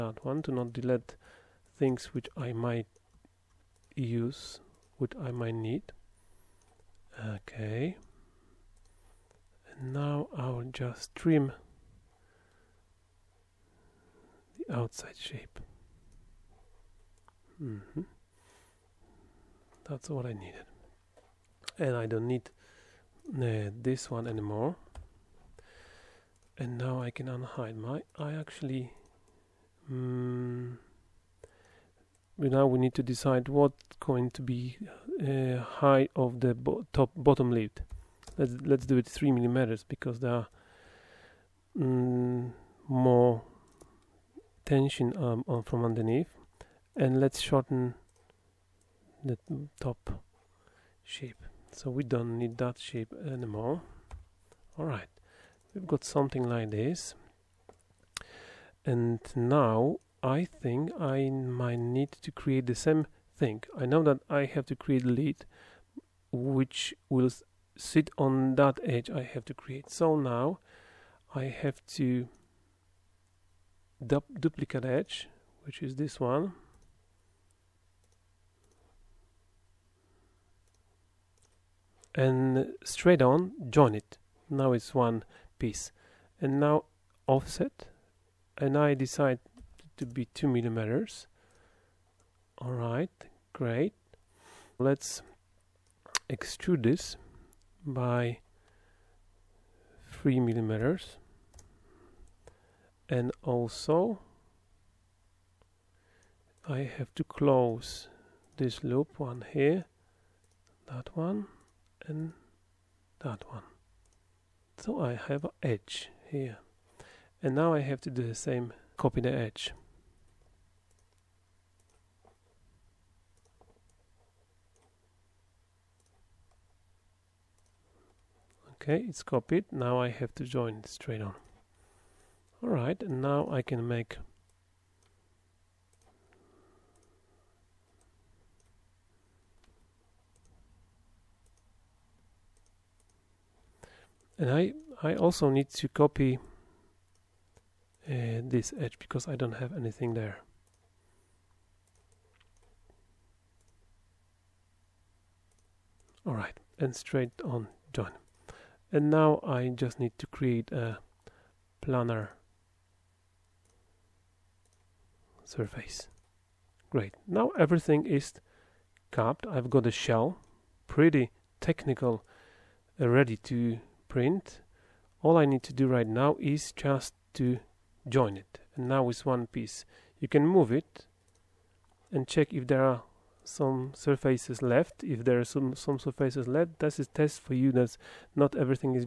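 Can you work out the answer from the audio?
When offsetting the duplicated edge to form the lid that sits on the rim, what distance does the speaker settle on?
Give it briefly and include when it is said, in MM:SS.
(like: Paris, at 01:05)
2 millimeters, at 01:30.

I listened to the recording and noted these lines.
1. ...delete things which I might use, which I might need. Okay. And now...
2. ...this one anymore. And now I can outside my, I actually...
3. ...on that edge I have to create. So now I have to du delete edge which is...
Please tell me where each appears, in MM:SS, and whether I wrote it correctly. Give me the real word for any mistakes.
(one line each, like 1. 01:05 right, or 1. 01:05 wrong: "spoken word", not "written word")
1. 00:00 right
2. 00:23 wrong: "unhide", not "outside"
3. 01:08 wrong: "duplicate", not "delete".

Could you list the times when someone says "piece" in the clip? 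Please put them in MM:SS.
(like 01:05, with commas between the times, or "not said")
01:25, 02:59.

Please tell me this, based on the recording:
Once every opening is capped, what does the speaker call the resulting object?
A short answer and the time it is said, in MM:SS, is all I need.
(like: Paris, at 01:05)
a shell, at 02:49.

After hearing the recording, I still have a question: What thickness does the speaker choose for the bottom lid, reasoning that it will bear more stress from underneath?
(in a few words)
3 millimeters.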